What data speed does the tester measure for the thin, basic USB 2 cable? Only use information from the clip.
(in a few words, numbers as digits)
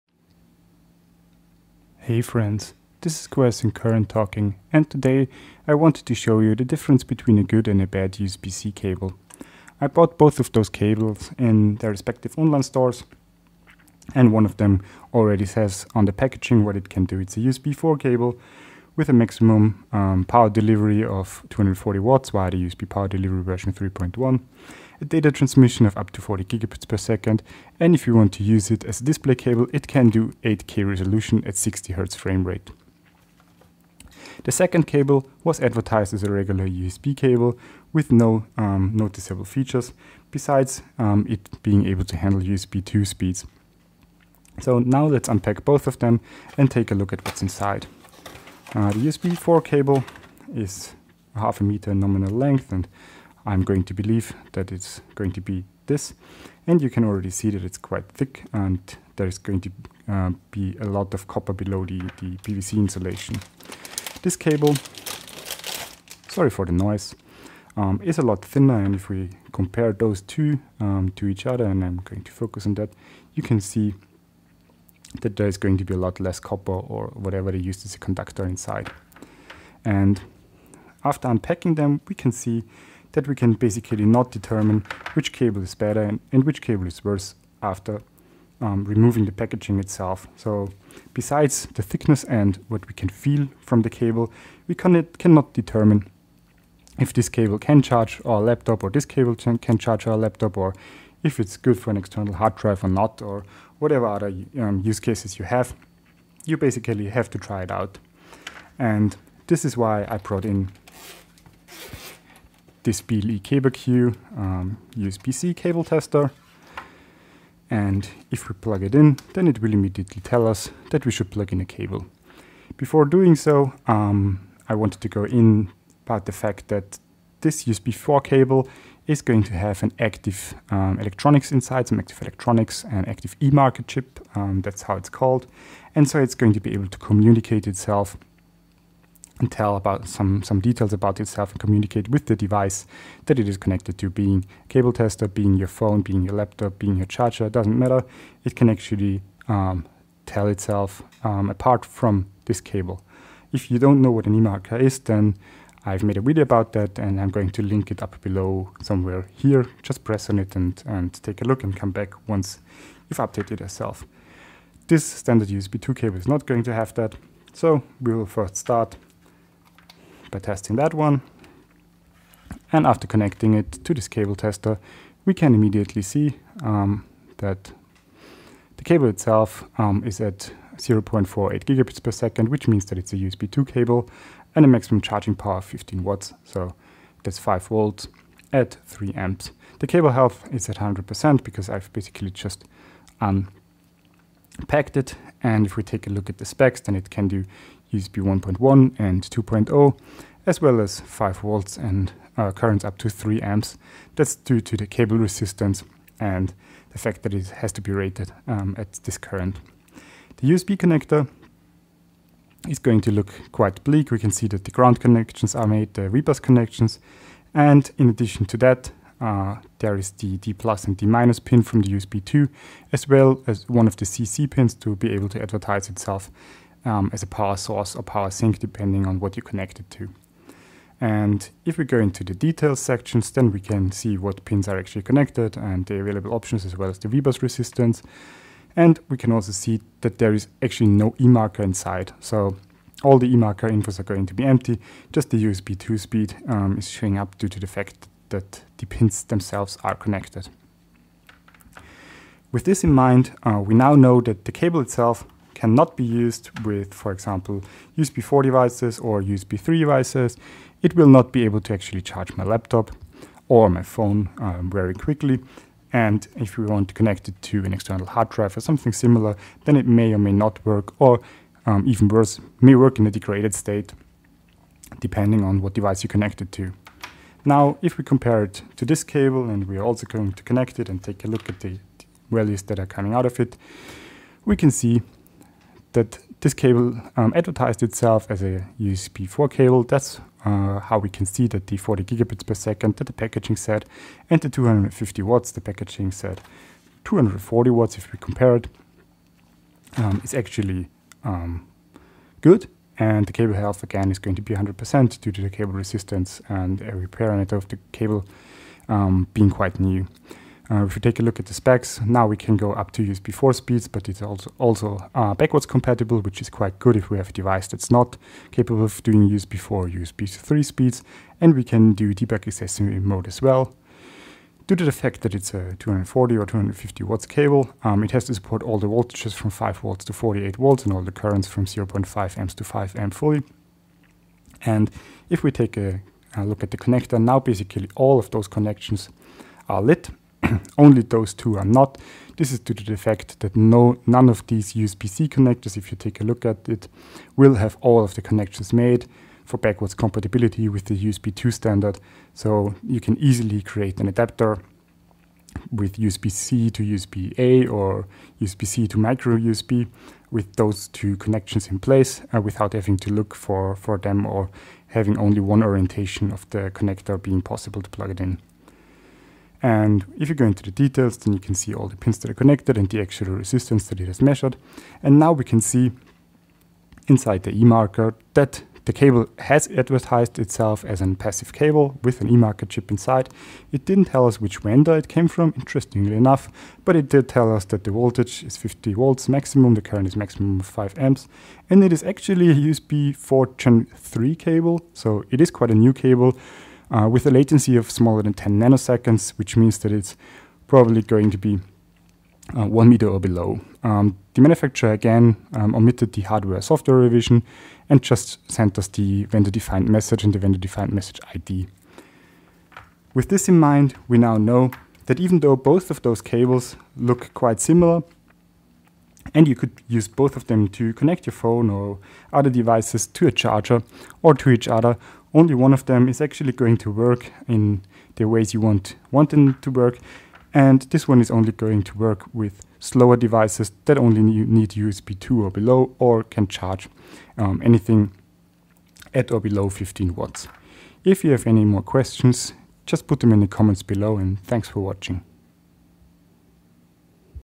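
0.48 gigabits per second.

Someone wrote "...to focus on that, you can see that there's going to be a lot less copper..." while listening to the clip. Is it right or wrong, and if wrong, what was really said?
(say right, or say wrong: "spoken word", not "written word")
right.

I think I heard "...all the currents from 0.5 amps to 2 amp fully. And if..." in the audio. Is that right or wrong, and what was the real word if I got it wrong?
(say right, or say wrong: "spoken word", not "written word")
wrong: "5", not "2".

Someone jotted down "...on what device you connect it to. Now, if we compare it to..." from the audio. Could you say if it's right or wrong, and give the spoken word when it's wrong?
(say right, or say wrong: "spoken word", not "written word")
right.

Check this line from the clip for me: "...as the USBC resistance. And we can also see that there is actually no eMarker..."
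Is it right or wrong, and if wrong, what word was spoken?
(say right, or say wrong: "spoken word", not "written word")
wrong: "VBUS", not "USBC".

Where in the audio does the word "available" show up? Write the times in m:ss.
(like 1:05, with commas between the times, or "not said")
3:55.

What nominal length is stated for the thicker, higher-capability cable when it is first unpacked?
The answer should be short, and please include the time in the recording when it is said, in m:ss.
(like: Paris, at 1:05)
half a meter, at 0:51.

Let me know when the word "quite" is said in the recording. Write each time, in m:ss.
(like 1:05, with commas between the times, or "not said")
0:57, 3:33, 5:09, 5:16, 6:35, 6:57.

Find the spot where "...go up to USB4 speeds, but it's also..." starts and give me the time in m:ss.
5:12.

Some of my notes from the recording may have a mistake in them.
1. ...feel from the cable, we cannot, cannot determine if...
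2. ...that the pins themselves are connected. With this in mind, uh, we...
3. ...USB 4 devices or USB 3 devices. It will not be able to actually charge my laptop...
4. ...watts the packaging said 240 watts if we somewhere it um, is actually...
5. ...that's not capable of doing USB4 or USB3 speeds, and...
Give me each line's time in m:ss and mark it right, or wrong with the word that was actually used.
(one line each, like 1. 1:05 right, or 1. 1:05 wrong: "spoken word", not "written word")
1. 1:33 right
2. 4:08 right
3. 4:17 right
4. 4:55 wrong: "compare", not "somewhere"
5. 5:17 right.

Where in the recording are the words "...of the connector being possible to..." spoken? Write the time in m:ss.
6:06.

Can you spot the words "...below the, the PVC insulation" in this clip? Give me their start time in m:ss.
1:01.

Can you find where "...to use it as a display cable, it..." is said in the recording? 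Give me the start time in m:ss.
0:28.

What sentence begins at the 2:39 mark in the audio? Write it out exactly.
Just press on it and, and take a look and come back once you've updated yourself.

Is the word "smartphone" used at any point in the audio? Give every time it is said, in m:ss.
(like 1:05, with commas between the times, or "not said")
not said.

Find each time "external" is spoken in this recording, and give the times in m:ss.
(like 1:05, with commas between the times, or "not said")
1:41, 4:27.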